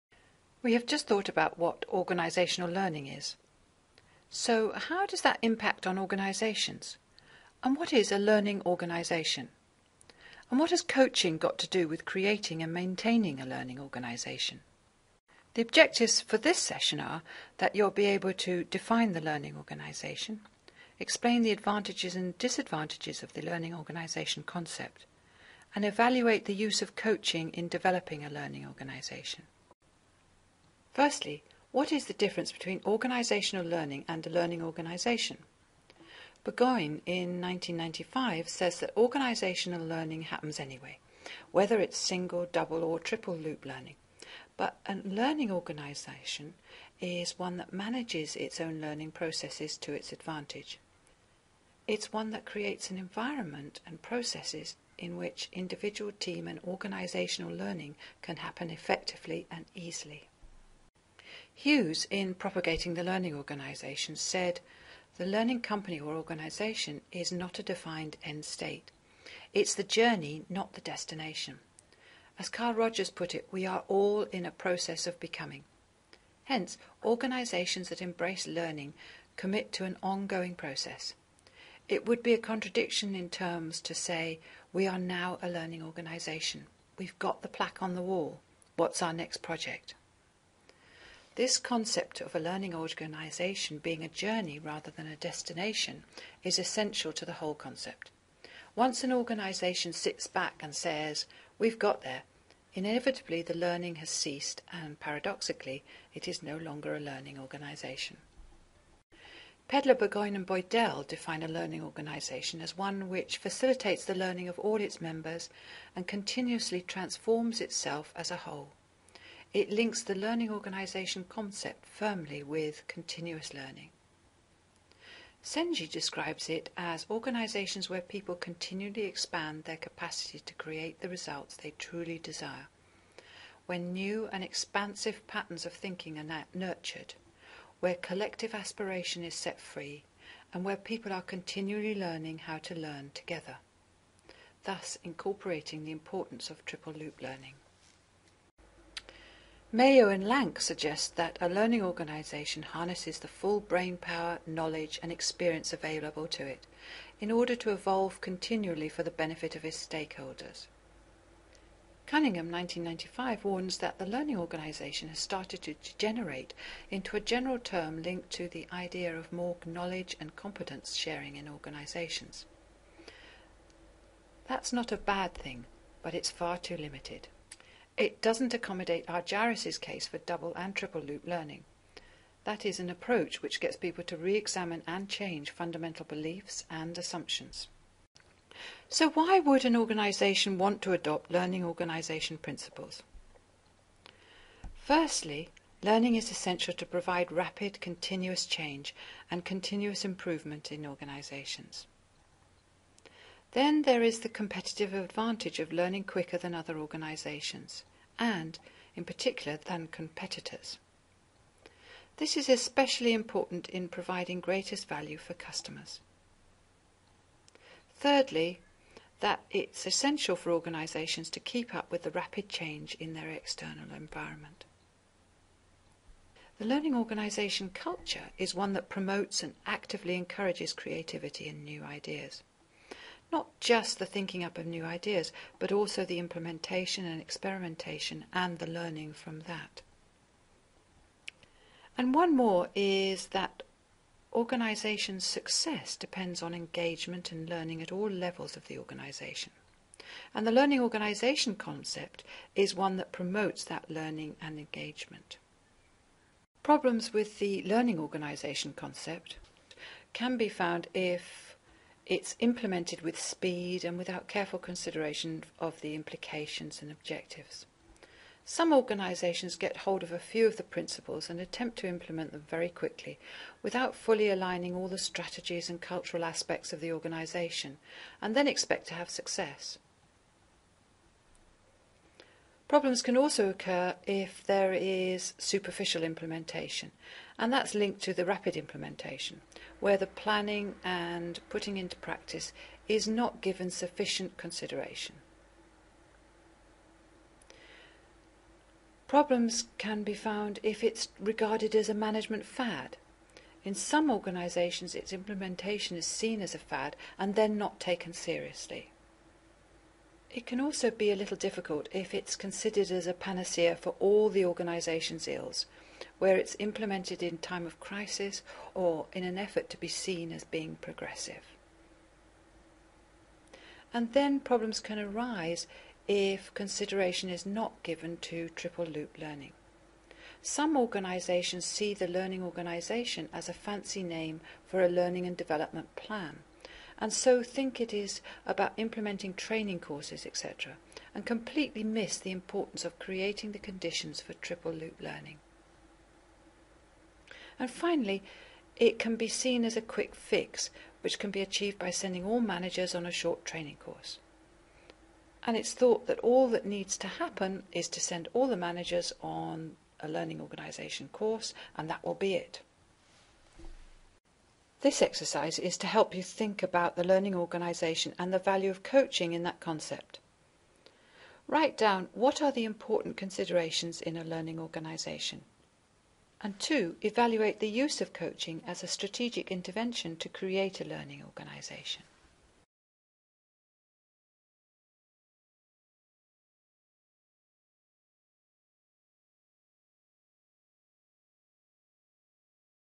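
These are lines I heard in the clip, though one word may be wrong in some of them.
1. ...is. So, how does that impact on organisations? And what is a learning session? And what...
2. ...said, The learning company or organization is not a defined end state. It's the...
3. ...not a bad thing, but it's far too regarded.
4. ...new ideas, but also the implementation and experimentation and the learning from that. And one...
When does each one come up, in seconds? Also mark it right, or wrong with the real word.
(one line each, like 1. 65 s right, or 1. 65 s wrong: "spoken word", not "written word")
1. 3 s wrong: "organisation", not "session"
2. 64 s right
3. 174 s wrong: "limited", not "regarded"
4. 234 s right.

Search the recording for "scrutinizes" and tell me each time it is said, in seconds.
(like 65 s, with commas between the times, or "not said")
not said.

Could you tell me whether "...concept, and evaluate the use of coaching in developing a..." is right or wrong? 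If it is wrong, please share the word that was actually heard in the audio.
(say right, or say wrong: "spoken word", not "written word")
right.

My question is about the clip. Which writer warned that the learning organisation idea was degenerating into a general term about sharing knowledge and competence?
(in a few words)
Cunningham.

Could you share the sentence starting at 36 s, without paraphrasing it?
Burgoyne in 1995 says that organisational learning happens anyway, whether it's single, double, or triple loop learning.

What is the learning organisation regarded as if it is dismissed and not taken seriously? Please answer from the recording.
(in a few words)
a management fad.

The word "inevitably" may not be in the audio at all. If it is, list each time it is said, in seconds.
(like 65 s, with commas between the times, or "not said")
102 s.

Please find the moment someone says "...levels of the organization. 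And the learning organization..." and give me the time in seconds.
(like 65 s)
248 s.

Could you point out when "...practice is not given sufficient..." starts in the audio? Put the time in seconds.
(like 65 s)
291 s.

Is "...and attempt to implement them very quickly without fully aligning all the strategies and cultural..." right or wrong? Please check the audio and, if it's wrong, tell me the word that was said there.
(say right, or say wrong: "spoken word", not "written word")
right.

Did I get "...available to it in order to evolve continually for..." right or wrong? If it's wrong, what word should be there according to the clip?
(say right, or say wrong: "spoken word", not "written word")
right.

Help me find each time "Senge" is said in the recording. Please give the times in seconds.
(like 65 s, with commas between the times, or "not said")
125 s.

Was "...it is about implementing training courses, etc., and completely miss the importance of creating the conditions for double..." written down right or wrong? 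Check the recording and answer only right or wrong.
wrong.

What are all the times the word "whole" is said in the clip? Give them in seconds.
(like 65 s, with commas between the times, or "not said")
97 s, 118 s.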